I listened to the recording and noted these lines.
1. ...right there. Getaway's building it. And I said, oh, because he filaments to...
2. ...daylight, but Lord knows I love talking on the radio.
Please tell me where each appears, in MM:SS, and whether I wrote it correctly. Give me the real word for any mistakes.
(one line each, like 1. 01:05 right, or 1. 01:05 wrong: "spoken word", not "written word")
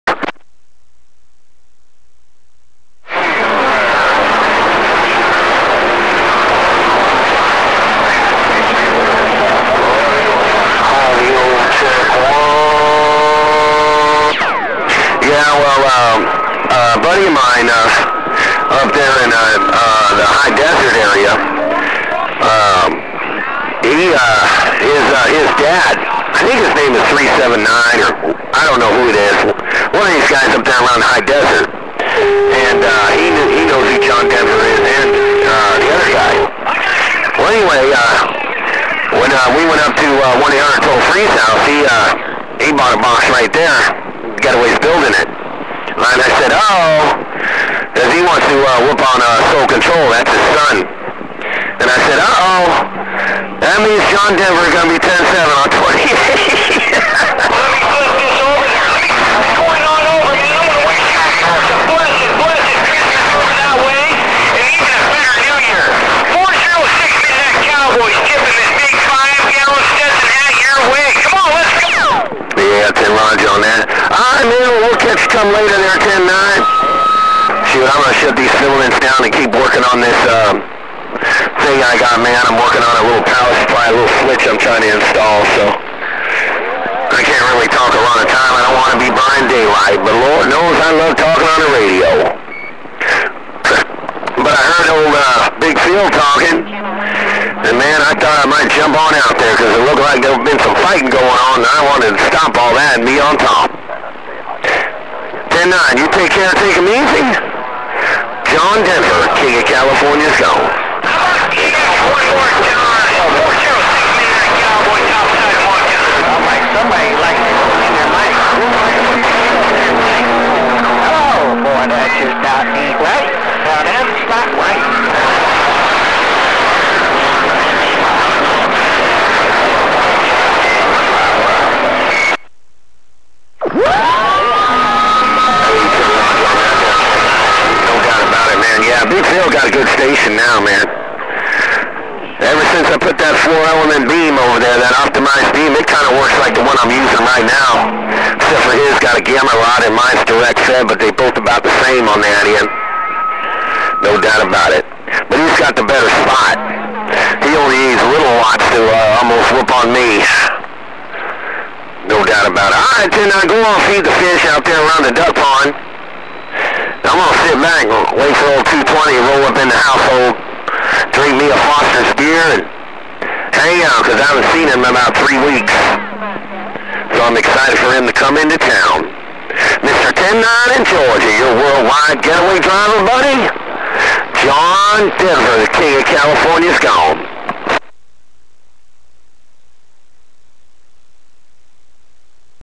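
1. 00:43 wrong: "wants", not "filaments"
2. 01:29 right.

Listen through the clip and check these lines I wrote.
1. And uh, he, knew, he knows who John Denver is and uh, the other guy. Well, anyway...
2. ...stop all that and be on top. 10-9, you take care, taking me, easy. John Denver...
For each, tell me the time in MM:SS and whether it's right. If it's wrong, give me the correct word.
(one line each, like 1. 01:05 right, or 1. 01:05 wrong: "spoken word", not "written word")
1. 00:31 right
2. 01:42 right.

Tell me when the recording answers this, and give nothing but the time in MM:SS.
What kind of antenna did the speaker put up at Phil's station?
02:23.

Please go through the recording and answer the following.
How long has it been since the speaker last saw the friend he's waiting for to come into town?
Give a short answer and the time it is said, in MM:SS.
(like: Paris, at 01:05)
3 weeks, at 02:55.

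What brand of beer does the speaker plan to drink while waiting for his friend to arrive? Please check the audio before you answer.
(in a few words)
Foster's.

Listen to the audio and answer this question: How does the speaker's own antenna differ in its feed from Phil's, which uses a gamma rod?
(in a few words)
Direct fed.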